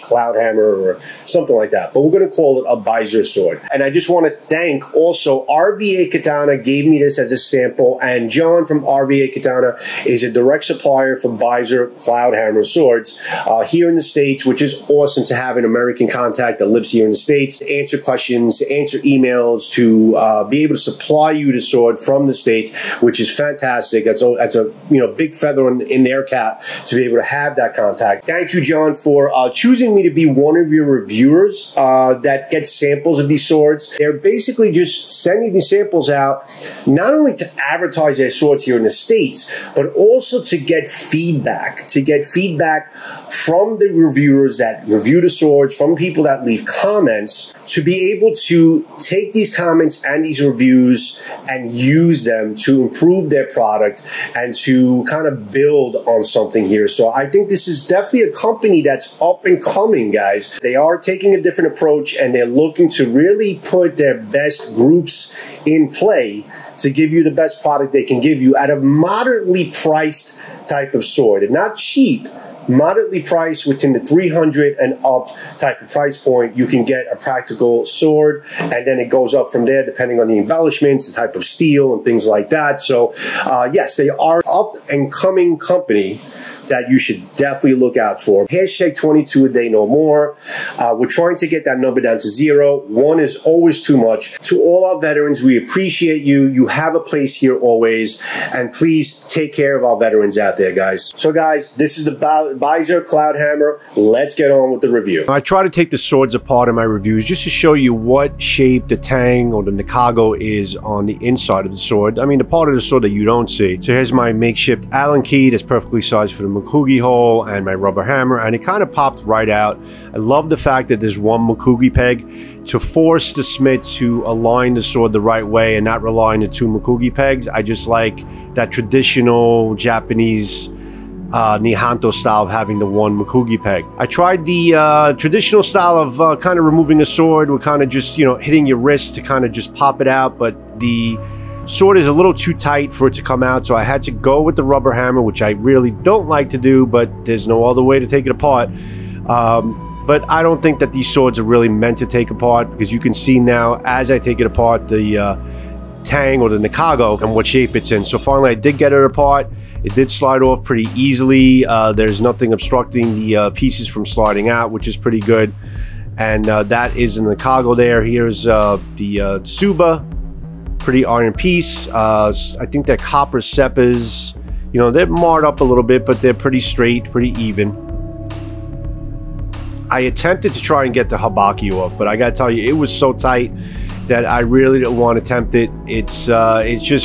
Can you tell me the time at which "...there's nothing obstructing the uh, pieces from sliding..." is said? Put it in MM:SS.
02:41.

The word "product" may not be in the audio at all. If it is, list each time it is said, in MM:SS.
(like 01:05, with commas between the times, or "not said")
00:53, 01:07.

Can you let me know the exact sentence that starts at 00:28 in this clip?
Thank you, John, for uh, choosing me to be one of your reviewers uh, that gets samples of these swords.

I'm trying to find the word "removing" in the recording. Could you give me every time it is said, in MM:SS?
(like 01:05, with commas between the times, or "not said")
02:16.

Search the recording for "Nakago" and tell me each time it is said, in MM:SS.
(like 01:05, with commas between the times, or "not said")
01:49, 02:36, 02:47.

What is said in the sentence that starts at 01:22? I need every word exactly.
So, uh, yes, they are up and coming company that you should definitely look out for.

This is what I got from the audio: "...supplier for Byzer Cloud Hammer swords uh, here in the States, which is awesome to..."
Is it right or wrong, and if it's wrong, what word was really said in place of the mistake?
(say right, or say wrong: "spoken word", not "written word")
right.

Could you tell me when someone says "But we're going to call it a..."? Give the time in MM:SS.
00:01.